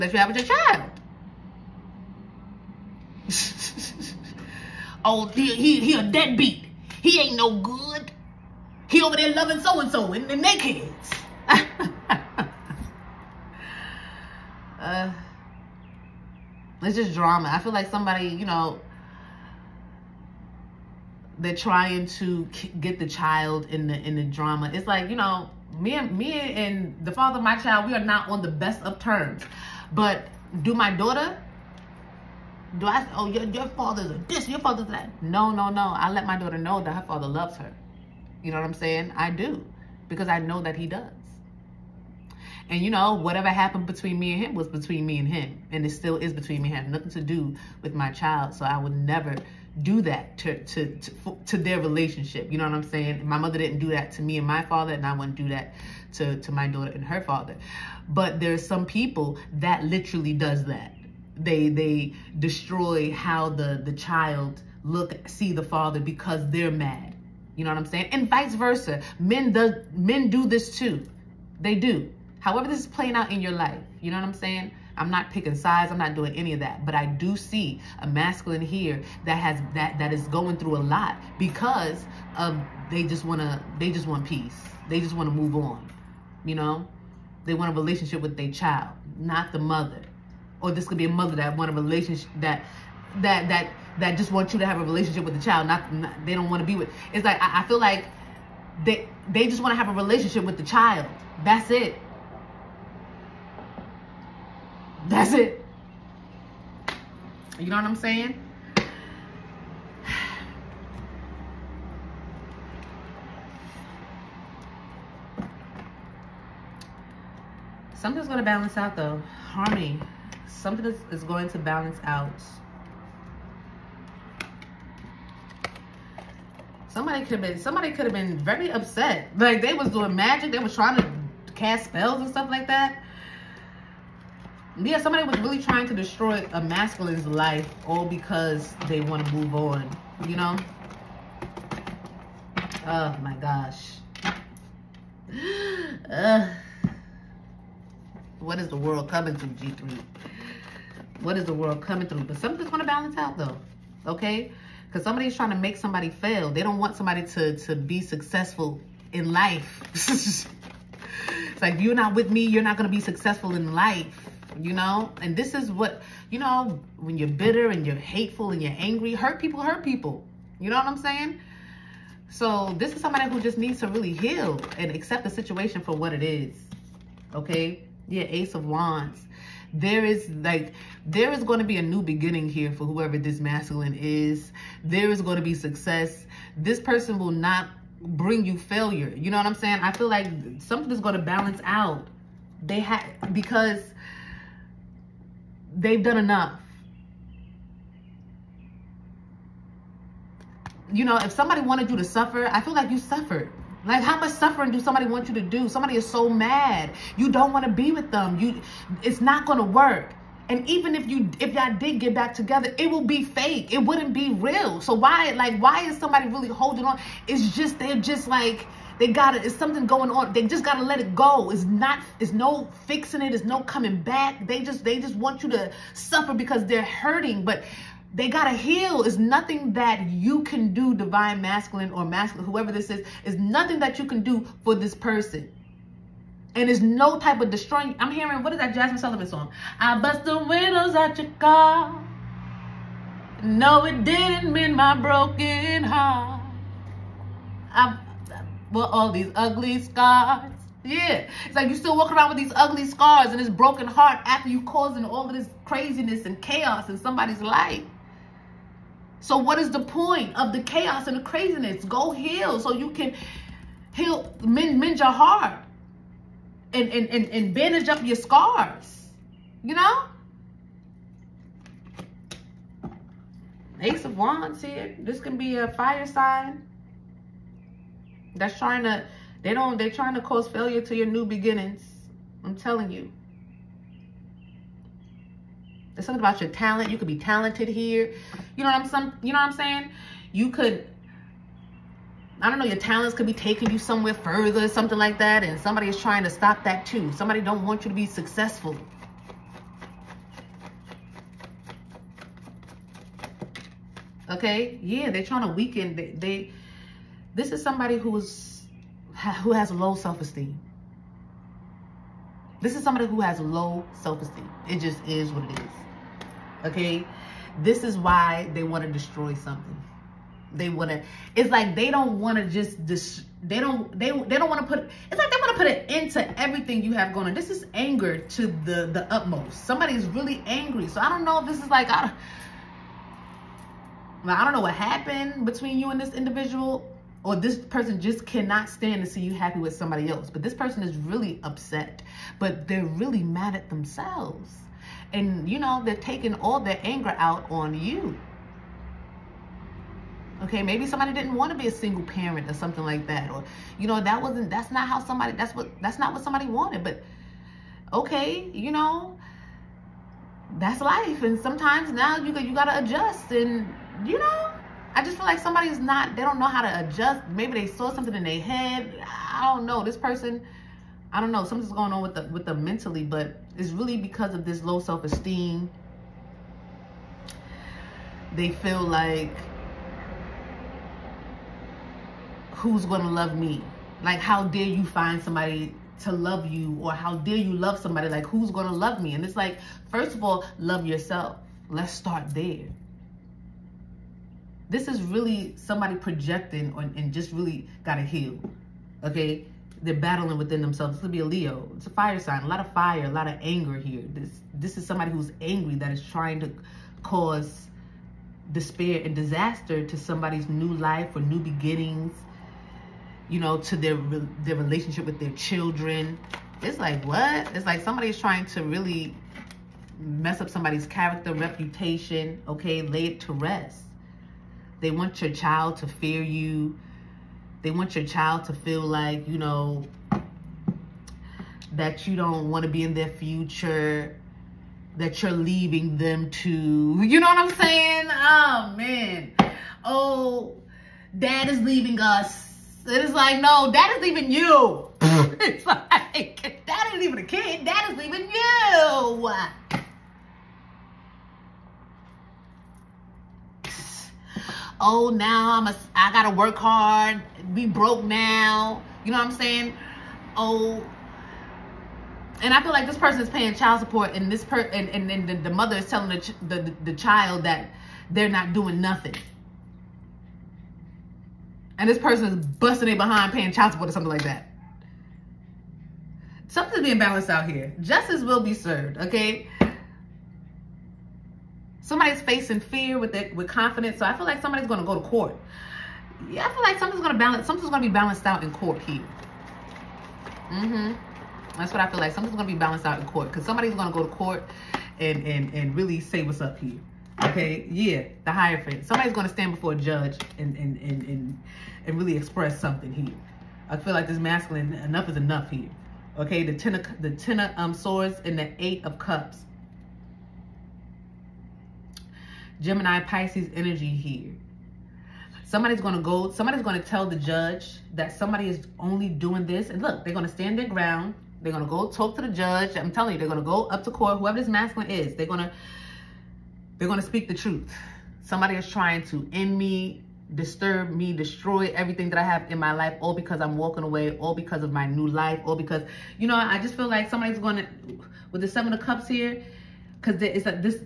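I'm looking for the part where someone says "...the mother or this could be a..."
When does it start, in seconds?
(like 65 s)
89 s.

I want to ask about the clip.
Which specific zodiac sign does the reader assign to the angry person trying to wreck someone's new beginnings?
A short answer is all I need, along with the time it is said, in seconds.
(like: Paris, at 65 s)
Leo, at 401 s.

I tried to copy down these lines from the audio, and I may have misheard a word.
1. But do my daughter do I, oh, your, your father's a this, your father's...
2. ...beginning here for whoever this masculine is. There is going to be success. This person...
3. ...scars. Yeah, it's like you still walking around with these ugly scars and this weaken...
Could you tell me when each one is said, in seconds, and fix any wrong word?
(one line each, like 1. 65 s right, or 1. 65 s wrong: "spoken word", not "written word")
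1. 29 s right
2. 182 s right
3. 249 s wrong: "broken", not "weaken".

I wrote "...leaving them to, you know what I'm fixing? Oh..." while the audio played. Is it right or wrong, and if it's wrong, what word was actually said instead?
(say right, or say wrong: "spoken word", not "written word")
wrong: "saying", not "fixing".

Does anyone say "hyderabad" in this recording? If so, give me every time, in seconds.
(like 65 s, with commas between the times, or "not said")
not said.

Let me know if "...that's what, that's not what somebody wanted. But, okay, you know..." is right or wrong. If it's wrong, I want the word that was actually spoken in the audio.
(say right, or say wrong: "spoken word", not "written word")
right.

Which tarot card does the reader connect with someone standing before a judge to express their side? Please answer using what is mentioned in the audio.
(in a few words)
the Hierophant.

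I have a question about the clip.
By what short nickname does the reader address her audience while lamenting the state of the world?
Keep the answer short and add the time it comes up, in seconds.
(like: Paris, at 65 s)
G3, at 149 s.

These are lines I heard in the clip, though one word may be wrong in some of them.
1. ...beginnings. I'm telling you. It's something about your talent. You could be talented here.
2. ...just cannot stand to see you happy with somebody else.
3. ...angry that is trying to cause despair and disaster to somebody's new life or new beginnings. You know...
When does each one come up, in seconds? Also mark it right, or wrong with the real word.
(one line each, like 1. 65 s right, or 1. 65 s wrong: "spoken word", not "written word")
1. 281 s right
2. 338 s right
3. 405 s right.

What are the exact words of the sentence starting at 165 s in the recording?
And this is what, you know, when you're bitter and you're hateful and you're angry, hurt people hurt people.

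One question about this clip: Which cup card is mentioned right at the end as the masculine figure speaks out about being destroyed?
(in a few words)
Seven of Cups.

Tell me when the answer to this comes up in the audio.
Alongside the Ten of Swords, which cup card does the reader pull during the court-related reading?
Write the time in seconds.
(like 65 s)
508 s.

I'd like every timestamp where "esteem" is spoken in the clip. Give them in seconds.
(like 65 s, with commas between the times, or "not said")
309 s, 314 s, 374 s.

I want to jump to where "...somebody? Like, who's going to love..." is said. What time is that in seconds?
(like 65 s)
387 s.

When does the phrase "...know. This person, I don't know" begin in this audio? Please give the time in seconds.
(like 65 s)
369 s.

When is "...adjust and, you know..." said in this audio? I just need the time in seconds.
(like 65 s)
362 s.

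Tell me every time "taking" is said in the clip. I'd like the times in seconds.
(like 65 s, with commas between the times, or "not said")
293 s, 345 s.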